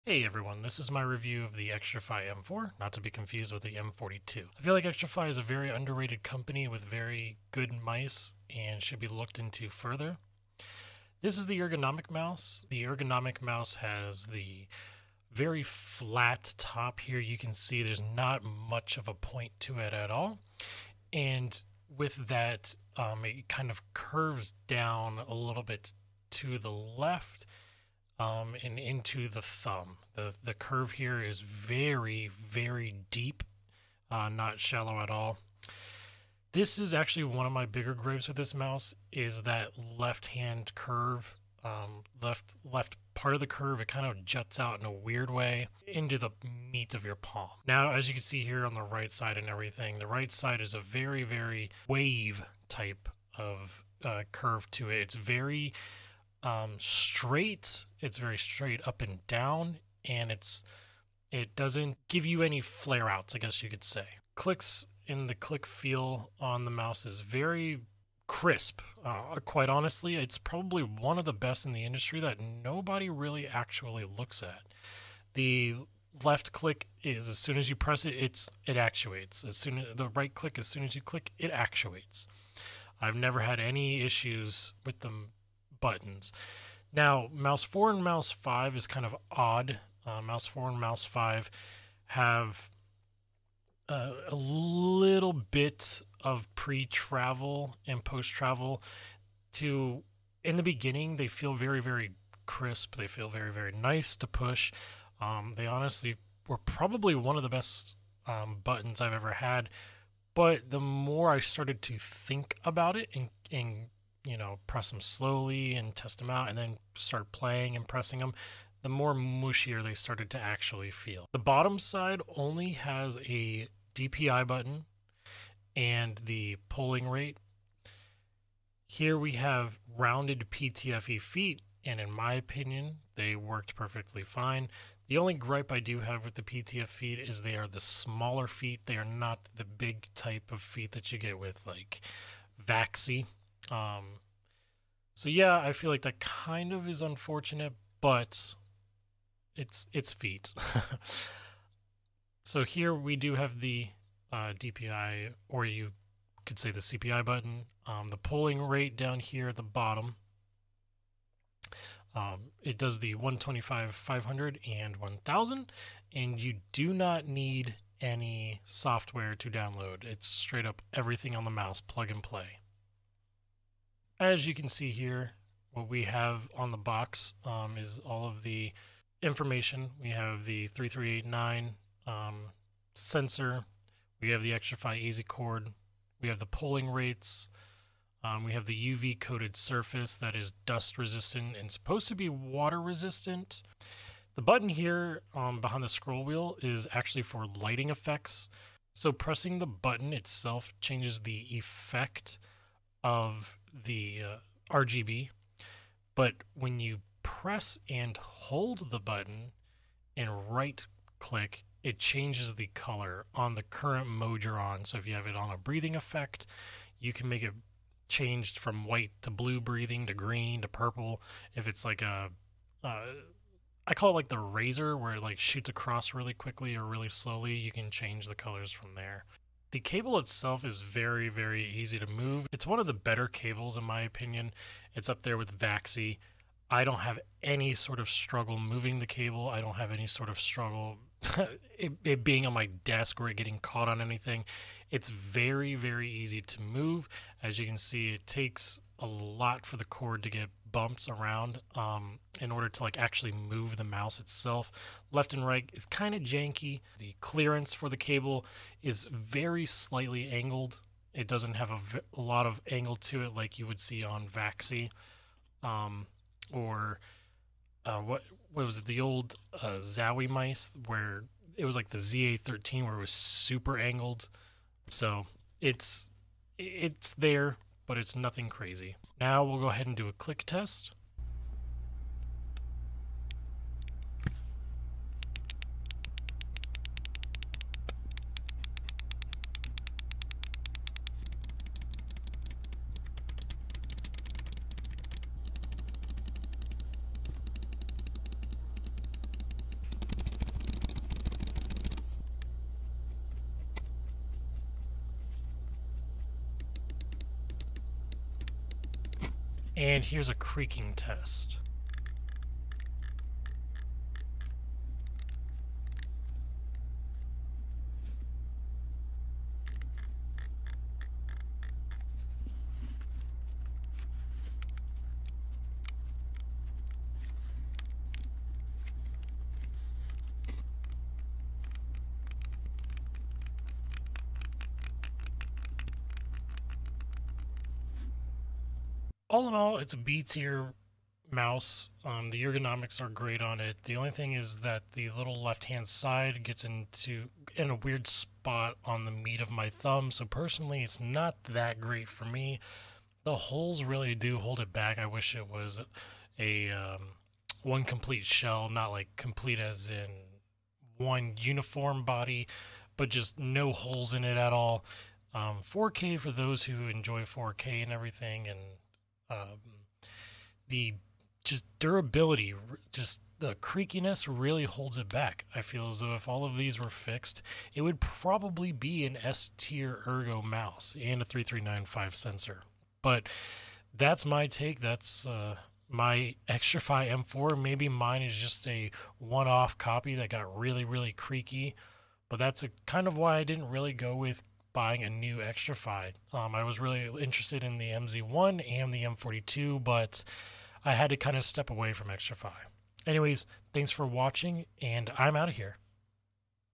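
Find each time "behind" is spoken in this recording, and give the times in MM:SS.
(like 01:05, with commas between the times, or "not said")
03:15.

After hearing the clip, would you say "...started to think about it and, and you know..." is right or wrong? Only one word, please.
right.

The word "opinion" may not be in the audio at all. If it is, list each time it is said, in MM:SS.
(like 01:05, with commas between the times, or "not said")
02:12, 03:54.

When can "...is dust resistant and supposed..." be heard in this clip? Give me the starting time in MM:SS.
03:10.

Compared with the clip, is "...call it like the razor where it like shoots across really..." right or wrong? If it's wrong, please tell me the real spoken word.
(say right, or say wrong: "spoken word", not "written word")
right.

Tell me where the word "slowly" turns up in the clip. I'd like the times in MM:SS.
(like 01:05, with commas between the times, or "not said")
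01:55, 03:47.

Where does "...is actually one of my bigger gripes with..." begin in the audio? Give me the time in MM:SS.
00:36.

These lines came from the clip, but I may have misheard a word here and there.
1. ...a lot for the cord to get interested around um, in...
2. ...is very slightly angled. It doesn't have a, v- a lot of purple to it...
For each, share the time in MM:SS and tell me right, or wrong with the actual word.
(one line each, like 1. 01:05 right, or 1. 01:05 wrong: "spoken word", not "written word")
1. 04:08 wrong: "bumped", not "interested"
2. 04:18 wrong: "angle", not "purple".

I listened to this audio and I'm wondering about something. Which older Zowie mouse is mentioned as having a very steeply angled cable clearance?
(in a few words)
ZA13.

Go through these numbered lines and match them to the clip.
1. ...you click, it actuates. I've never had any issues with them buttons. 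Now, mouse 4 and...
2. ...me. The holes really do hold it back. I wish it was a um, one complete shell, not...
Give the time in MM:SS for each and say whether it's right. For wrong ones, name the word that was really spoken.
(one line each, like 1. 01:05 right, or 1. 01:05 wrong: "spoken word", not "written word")
1. 01:20 right
2. 05:52 right.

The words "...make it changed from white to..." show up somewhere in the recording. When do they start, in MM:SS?
03:37.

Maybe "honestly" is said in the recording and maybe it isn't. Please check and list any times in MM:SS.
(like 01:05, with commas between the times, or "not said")
01:09, 01:45.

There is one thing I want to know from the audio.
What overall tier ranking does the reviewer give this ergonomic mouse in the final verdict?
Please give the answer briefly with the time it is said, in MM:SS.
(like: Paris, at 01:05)
B tier, at 05:39.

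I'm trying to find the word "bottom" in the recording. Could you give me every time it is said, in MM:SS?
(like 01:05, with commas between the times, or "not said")
02:01, 02:39.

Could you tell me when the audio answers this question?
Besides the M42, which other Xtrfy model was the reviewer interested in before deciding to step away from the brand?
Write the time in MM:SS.
06:37.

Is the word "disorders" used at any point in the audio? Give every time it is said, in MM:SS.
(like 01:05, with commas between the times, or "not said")
not said.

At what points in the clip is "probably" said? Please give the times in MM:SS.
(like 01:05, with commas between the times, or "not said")
01:10, 01:46, 06:17.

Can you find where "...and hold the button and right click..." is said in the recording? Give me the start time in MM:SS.
03:27.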